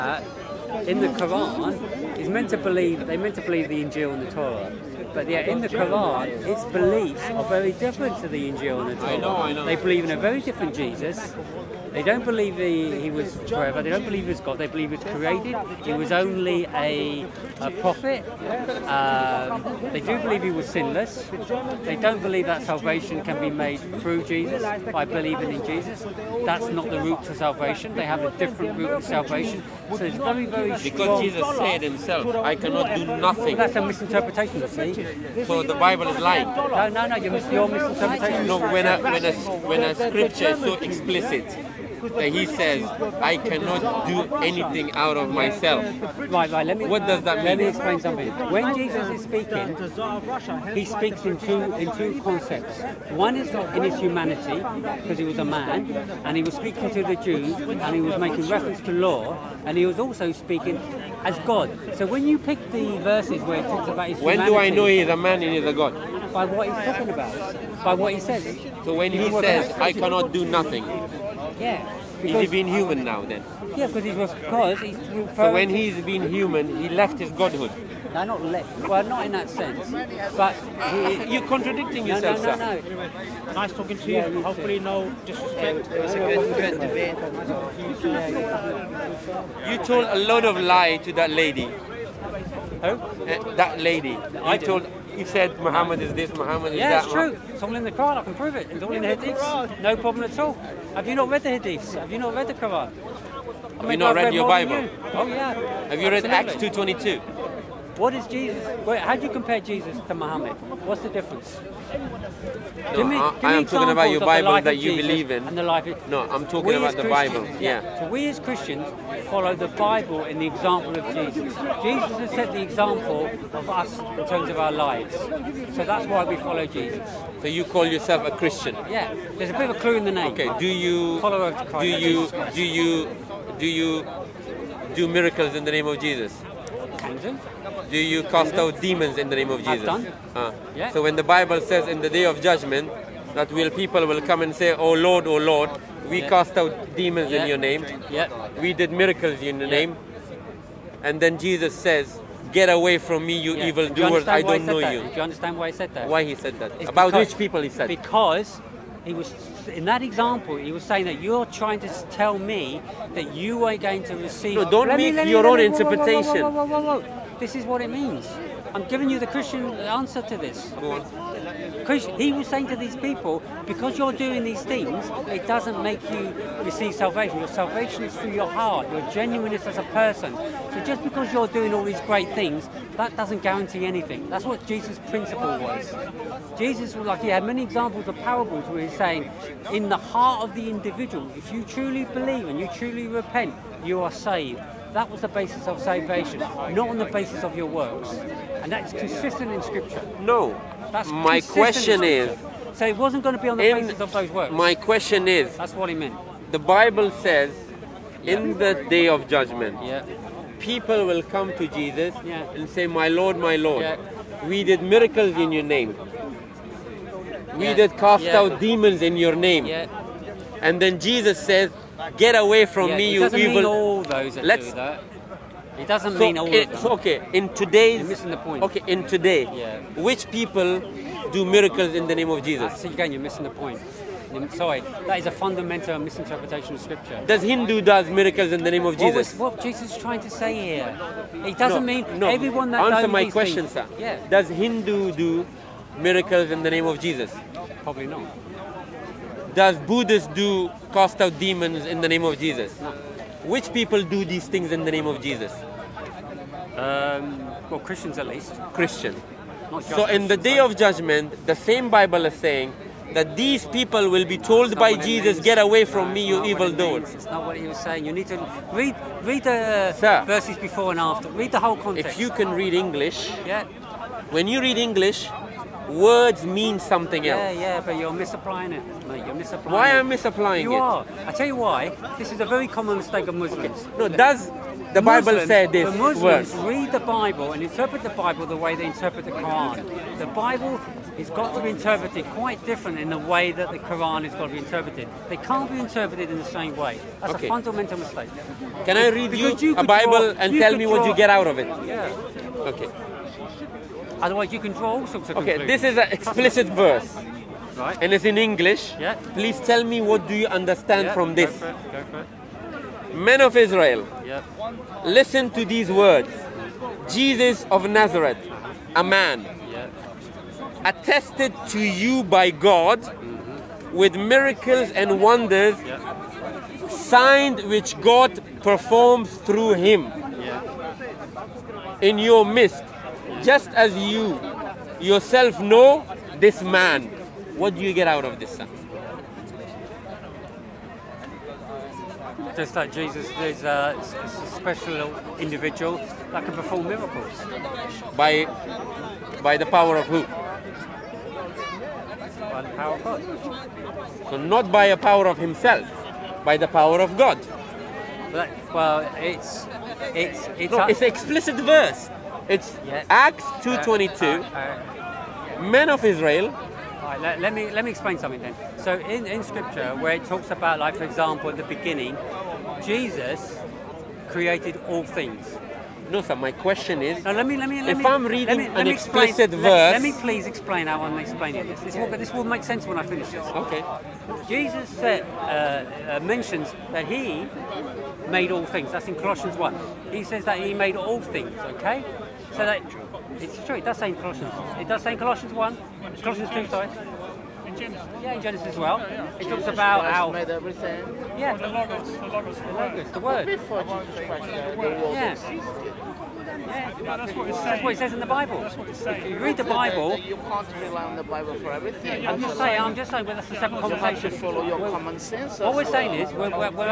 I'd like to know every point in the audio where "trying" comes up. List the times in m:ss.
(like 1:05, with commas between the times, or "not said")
2:41, 3:59.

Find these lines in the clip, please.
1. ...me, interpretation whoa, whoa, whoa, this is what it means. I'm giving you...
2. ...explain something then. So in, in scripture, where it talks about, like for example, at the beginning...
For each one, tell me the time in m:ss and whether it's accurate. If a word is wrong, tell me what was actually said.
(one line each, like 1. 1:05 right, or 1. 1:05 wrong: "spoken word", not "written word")
1. 2:45 right
2. 6:07 right.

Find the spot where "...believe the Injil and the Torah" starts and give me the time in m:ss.
0:03.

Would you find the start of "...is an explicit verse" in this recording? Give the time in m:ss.
5:05.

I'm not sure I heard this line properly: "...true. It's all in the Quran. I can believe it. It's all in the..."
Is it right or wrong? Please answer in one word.
wrong.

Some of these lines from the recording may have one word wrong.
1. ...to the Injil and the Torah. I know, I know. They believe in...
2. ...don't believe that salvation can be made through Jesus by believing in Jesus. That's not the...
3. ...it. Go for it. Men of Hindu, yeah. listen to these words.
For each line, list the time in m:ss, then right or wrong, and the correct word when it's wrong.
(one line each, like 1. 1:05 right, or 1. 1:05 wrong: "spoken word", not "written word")
1. 0:08 right
2. 0:21 right
3. 5:11 wrong: "Israel", not "Hindu".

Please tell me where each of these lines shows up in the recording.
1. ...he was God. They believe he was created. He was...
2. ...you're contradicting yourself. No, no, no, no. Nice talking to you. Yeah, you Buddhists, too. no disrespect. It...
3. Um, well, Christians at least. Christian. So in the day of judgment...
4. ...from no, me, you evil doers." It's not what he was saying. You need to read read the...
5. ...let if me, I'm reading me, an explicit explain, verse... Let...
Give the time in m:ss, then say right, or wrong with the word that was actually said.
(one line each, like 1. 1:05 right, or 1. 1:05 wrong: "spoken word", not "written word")
1. 0:14 right
2. 1:21 wrong: "Hopefully", not "Buddhists"
3. 4:16 right
4. 4:25 right
5. 6:17 right.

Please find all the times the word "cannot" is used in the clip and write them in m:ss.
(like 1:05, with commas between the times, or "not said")
0:32, 0:43, 1:09.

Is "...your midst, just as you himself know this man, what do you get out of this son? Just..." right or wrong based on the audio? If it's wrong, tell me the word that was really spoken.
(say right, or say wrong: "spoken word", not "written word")
wrong: "yourself", not "himself".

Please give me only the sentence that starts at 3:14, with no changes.
That was the basis of salvation, not on the basis of your works.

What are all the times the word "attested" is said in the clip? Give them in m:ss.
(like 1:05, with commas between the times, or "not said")
5:20.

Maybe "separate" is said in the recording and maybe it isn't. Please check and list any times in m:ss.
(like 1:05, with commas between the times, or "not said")
6:53.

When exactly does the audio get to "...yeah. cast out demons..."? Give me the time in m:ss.
2:26.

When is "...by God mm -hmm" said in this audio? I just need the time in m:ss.
5:22.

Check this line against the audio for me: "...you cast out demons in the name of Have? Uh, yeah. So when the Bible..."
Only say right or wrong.
wrong.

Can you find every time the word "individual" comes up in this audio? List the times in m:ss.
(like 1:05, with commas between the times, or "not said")
3:10, 5:45.